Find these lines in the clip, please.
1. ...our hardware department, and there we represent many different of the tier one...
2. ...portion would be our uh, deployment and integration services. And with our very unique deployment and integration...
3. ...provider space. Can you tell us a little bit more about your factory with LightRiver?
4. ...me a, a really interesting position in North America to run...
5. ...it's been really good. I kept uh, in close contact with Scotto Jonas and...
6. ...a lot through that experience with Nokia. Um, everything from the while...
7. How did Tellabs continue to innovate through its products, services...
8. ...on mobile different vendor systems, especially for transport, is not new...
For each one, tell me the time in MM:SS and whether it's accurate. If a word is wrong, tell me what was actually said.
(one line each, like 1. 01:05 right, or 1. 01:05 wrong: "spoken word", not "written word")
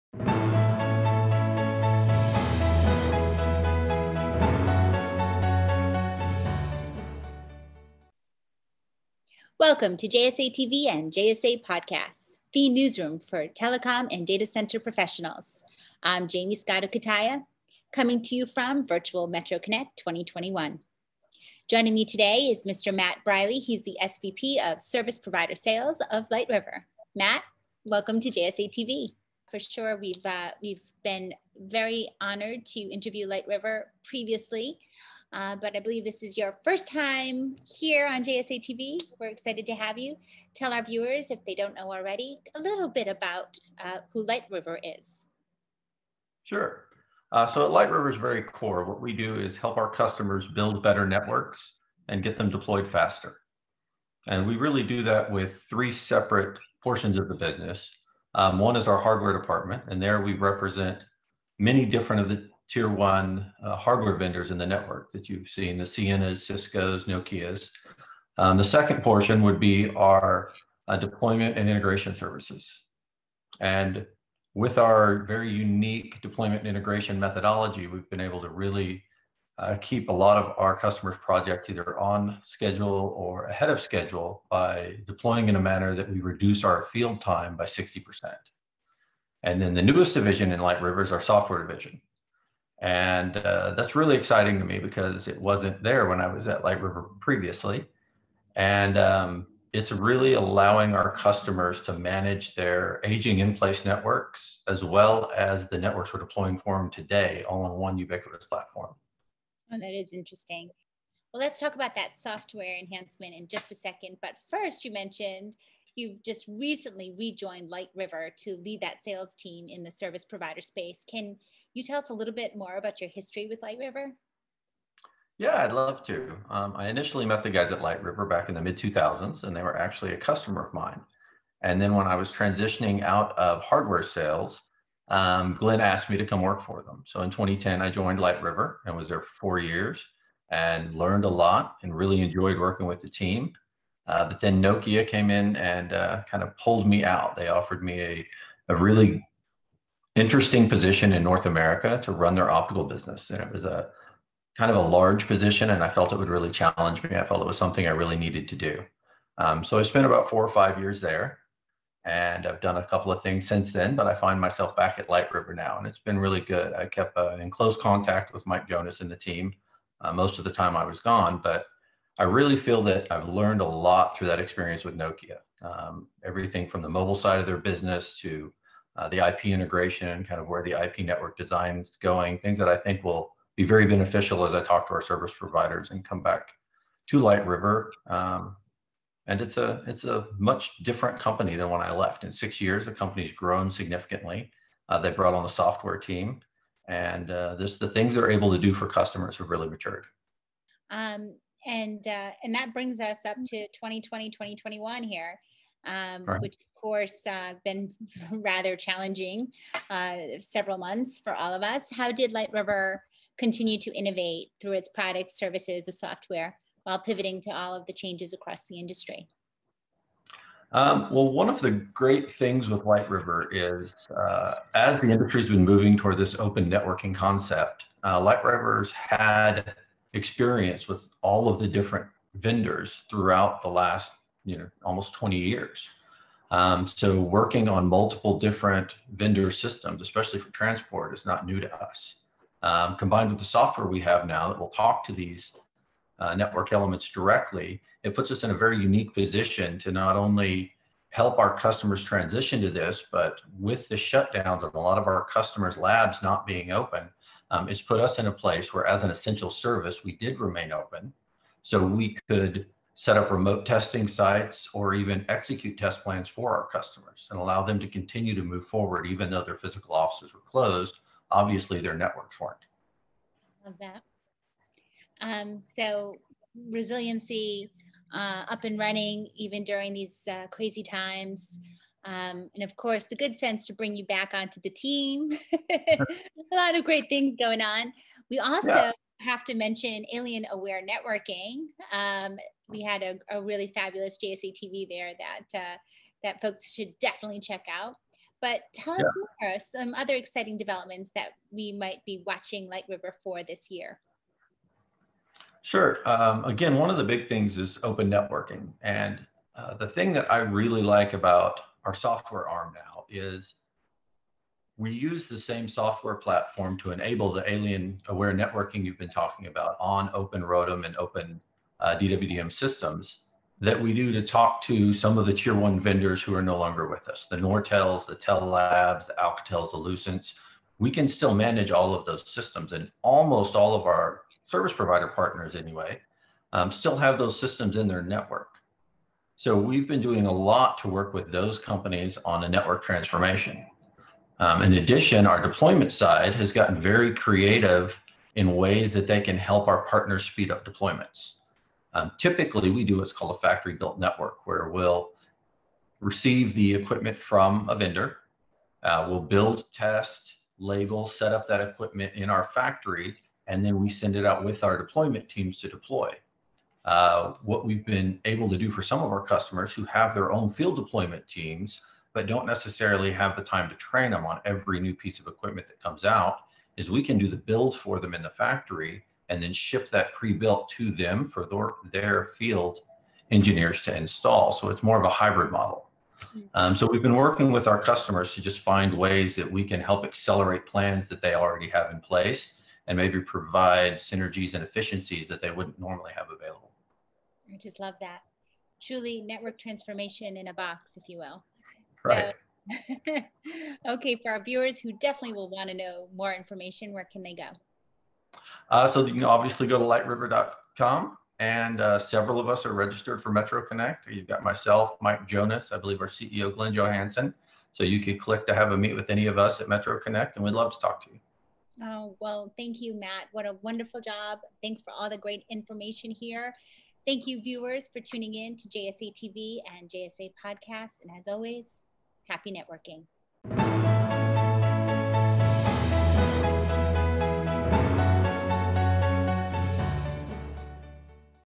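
1. 00:58 right
2. 01:09 right
3. 02:00 wrong: "history", not "factory"
4. 02:27 right
5. 02:45 wrong: "Mike", not "Scotto"
6. 02:53 wrong: "mobile", not "while"
7. 03:31 wrong: "LightRiver", not "Tellabs"
8. 03:57 wrong: "multiple", not "mobile".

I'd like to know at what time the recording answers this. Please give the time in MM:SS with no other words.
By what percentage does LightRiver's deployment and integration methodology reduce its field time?
01:27.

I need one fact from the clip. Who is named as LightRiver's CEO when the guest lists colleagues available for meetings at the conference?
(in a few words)
Glenn Johansson.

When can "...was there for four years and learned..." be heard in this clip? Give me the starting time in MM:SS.
02:18.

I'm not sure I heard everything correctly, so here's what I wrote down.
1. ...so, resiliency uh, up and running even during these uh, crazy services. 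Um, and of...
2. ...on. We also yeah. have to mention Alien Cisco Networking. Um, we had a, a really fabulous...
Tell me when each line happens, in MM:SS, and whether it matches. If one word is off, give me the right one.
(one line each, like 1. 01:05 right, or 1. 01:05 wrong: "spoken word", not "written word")
1. 04:35 wrong: "times", not "services"
2. 04:47 wrong: "Wave", not "Cisco".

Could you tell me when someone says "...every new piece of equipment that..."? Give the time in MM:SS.
06:14.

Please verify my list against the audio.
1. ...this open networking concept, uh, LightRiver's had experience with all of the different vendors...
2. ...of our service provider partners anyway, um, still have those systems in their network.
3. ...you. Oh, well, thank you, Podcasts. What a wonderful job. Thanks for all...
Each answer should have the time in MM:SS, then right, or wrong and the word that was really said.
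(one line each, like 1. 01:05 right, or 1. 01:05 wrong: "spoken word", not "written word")
1. 03:46 right
2. 05:33 right
3. 07:01 wrong: "Matt", not "Podcasts".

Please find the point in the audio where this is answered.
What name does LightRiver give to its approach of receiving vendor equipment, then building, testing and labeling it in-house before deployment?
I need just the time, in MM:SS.
05:53.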